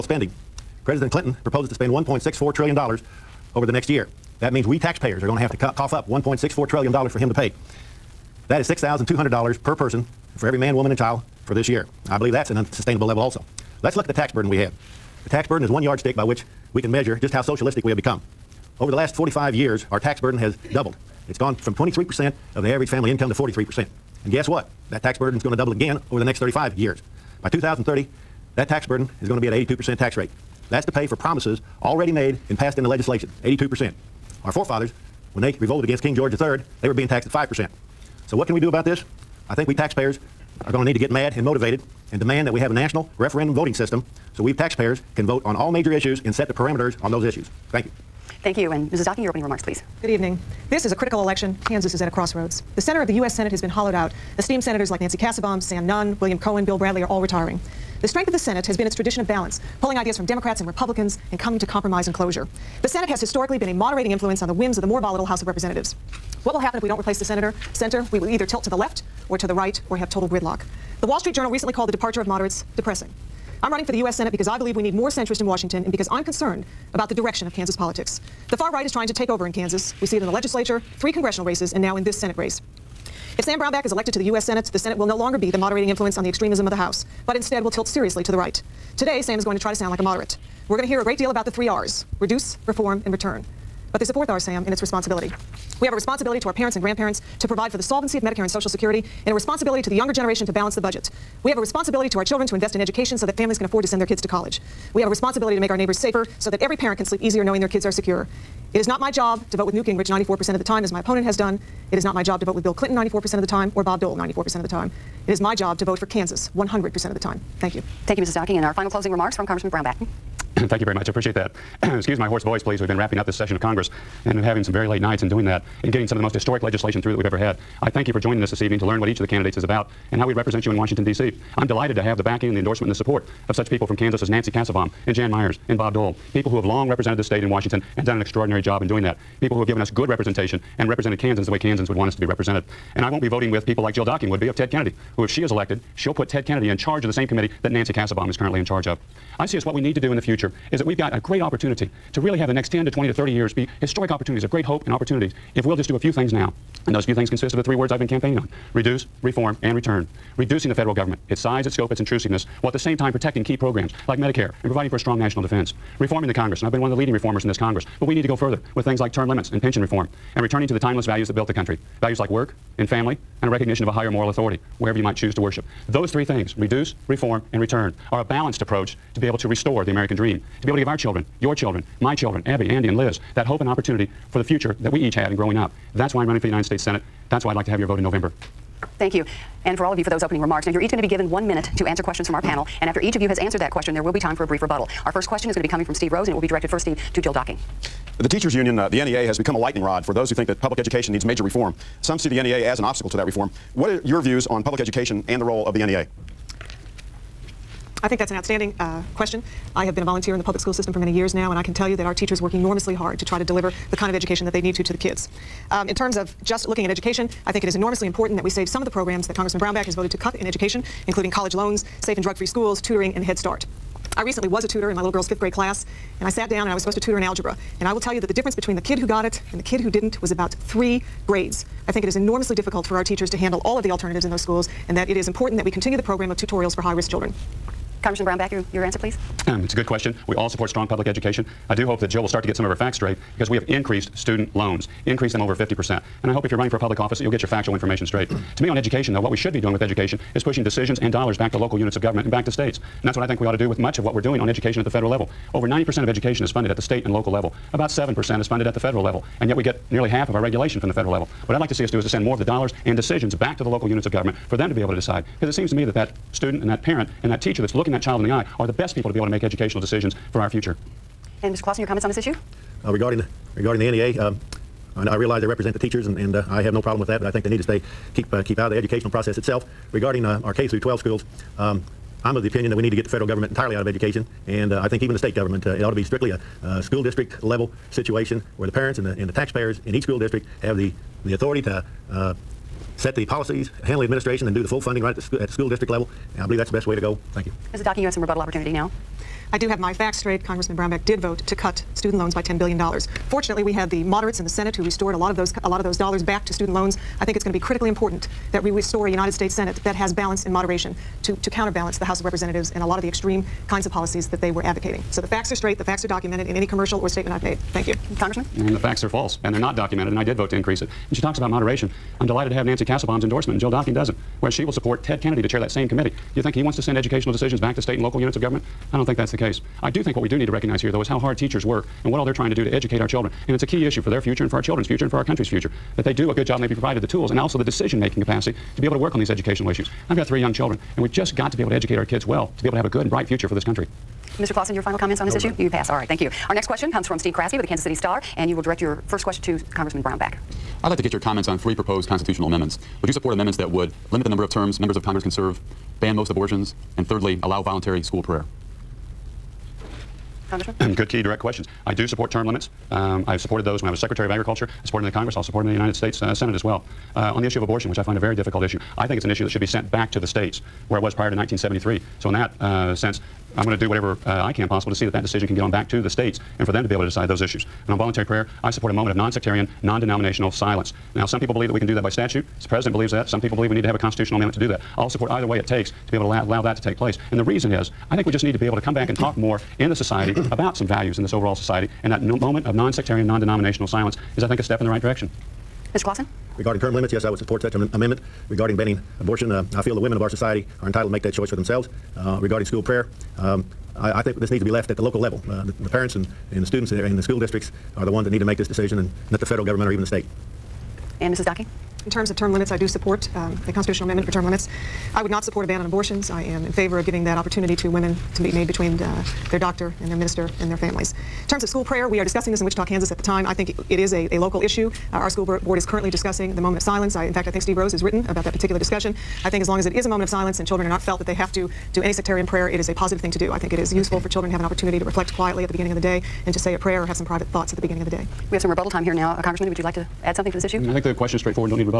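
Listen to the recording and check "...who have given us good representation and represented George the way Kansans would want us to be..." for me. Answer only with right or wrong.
wrong.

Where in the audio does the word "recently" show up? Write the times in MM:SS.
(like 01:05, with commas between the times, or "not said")
01:11, 03:44.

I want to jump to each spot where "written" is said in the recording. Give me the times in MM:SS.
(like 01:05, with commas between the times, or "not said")
07:08.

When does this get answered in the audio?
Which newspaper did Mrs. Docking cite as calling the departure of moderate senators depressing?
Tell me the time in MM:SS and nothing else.
01:11.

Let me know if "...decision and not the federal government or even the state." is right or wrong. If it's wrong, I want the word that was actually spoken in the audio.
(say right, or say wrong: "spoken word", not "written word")
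right.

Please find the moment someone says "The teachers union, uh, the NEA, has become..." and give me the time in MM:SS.
03:18.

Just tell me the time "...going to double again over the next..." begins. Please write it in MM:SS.
00:25.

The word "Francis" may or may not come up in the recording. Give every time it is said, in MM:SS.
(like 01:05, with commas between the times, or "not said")
not said.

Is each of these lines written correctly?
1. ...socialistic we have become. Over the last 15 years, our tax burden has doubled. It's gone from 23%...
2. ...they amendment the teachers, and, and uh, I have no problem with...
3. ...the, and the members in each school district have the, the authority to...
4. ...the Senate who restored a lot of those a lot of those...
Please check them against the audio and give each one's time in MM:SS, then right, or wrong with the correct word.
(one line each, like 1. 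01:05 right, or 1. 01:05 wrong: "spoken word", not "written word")
1. 00:17 wrong: "45", not "15"
2. 04:35 wrong: "represent", not "amendment"
3. 04:49 wrong: "taxpayers", not "members"
4. 05:04 right.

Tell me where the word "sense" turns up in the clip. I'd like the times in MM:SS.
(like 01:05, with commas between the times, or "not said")
06:12.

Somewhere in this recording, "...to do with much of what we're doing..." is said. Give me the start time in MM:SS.
04:13.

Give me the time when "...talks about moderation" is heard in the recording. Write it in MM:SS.
05:21.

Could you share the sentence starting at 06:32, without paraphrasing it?
And that no moment of non-sectarian, non-denominational silence is, I think, a step in the right direction.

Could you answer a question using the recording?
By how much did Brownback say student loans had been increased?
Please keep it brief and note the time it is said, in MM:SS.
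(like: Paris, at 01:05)
over 50%, at 04:05.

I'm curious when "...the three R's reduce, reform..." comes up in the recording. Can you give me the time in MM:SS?
01:31.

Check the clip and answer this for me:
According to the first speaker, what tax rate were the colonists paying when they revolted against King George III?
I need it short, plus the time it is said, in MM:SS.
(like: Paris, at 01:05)
5%, at 00:37.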